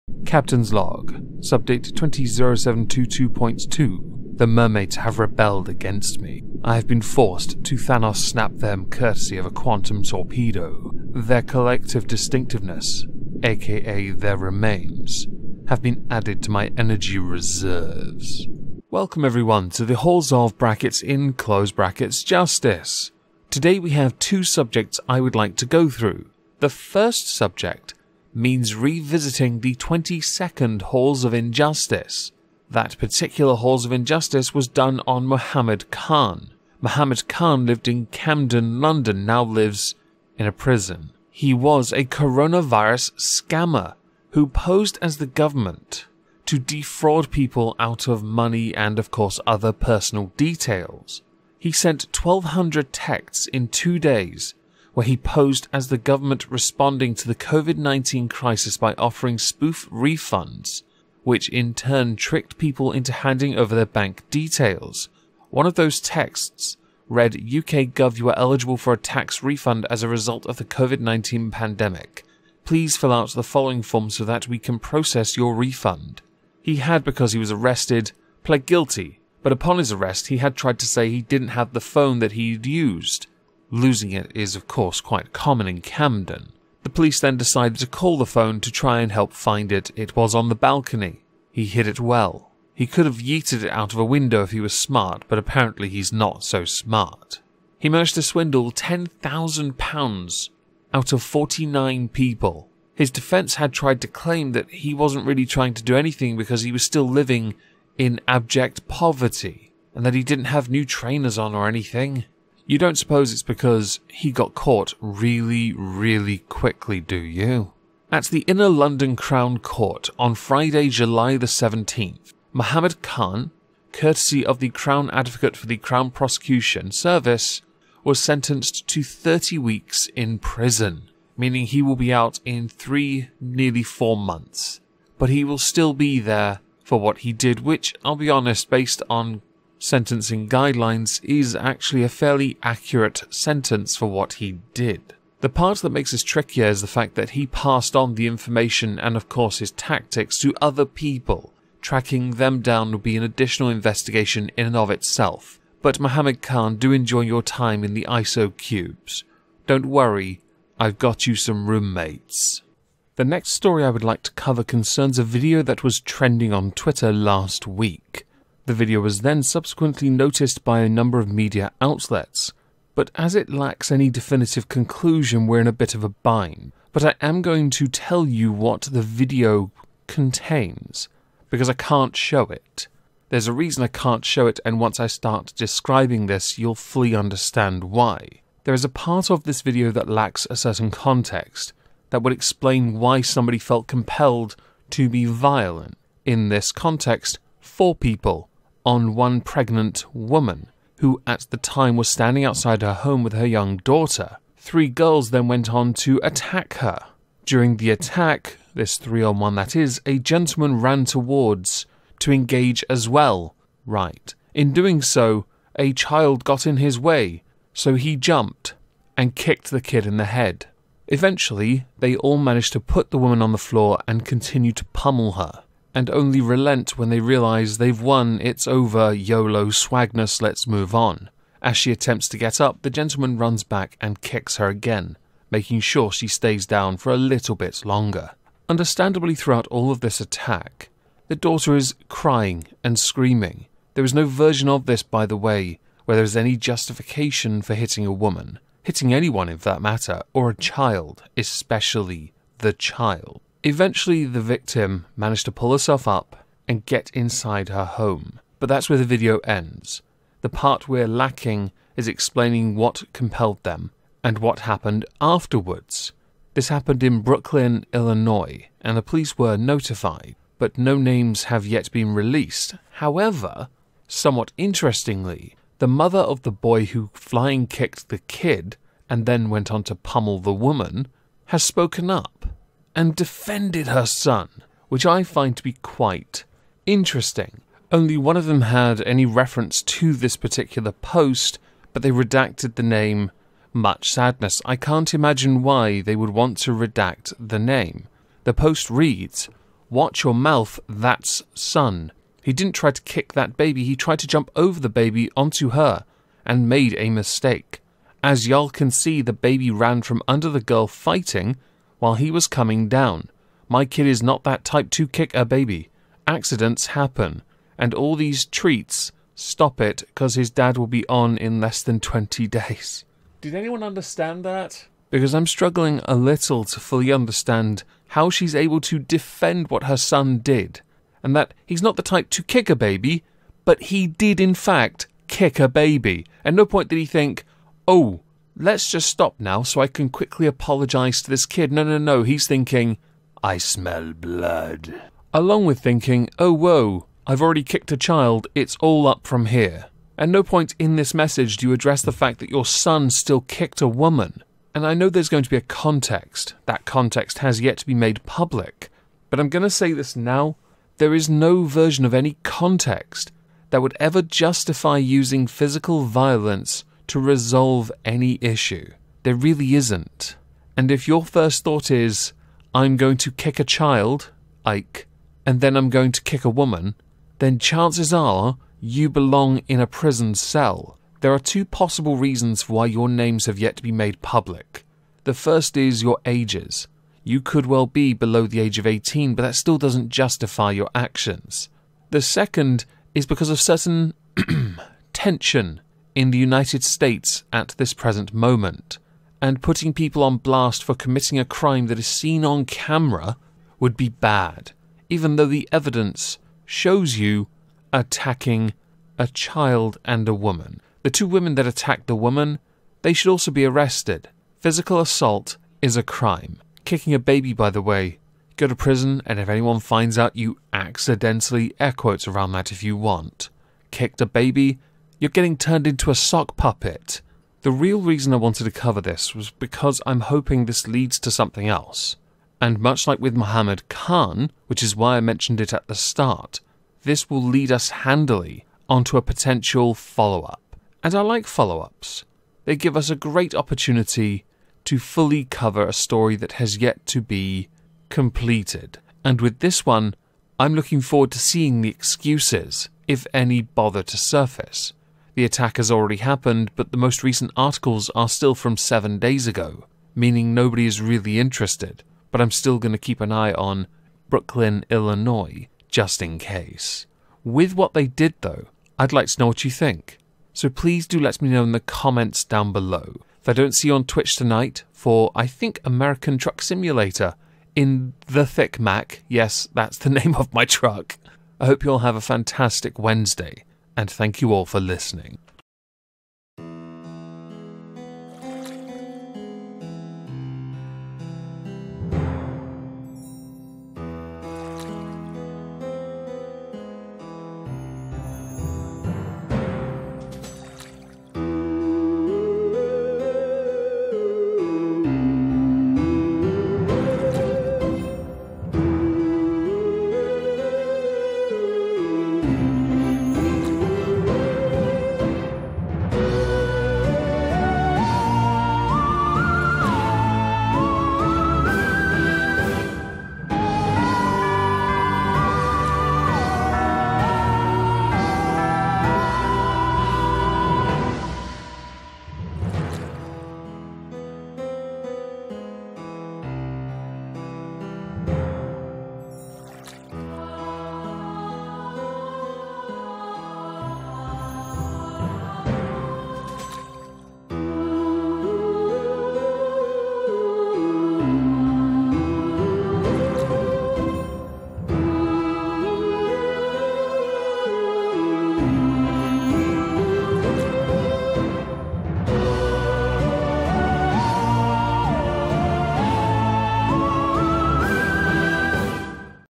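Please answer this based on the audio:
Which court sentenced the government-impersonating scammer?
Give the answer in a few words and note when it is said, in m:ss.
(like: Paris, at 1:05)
Inner London Crown Court, at 1:58.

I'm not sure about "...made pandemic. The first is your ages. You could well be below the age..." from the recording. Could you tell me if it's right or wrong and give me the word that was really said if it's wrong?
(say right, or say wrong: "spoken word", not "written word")
wrong: "public", not "pandemic".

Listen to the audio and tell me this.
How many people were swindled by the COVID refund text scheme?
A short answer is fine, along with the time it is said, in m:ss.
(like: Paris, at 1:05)
49, at 1:41.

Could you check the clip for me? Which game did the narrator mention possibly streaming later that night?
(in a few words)
American Truck Simulator.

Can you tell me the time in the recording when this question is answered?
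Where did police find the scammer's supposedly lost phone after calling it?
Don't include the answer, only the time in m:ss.
1:30.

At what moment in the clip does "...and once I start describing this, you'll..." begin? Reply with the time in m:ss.
3:04.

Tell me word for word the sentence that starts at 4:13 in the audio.
Eventually, the victim managed to pull herself up and get inside her home.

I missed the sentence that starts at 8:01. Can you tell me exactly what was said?
I hope you all have a fantastic Wednesday and thank you all for listening.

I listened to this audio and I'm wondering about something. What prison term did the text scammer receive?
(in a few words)
30 weeks.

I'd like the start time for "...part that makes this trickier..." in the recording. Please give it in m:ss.
2:25.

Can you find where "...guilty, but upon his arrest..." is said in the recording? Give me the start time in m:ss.
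1:18.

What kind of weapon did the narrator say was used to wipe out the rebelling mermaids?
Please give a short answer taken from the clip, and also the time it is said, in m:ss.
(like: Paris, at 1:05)
Quantum torpedo, at 0:09.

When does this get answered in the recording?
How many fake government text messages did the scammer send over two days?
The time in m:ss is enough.
0:52.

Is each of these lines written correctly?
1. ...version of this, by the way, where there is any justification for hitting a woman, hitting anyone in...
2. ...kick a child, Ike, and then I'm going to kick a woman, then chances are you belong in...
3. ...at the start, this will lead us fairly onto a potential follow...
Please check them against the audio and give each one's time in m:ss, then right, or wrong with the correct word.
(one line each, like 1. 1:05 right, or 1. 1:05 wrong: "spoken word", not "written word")
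1. 4:04 right
2. 6:13 right
3. 7:15 wrong: "handily", not "fairly".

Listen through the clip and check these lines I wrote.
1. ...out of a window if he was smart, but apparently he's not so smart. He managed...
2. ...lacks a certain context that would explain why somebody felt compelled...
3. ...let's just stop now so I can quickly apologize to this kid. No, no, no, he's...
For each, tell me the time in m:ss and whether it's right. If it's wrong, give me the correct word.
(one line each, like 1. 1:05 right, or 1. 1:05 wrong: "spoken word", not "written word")
1. 1:33 right
2. 3:10 right
3. 5:38 right.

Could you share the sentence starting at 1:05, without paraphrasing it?
One of those texts read UK Gov, you are eligible for a tax refund as a result of the COVID 19 pandemic.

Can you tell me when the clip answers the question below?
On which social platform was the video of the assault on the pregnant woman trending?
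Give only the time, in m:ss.
2:46.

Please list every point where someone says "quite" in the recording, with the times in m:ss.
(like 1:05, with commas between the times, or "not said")
1:24, 4:45.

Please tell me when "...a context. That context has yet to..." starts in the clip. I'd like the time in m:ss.
5:55.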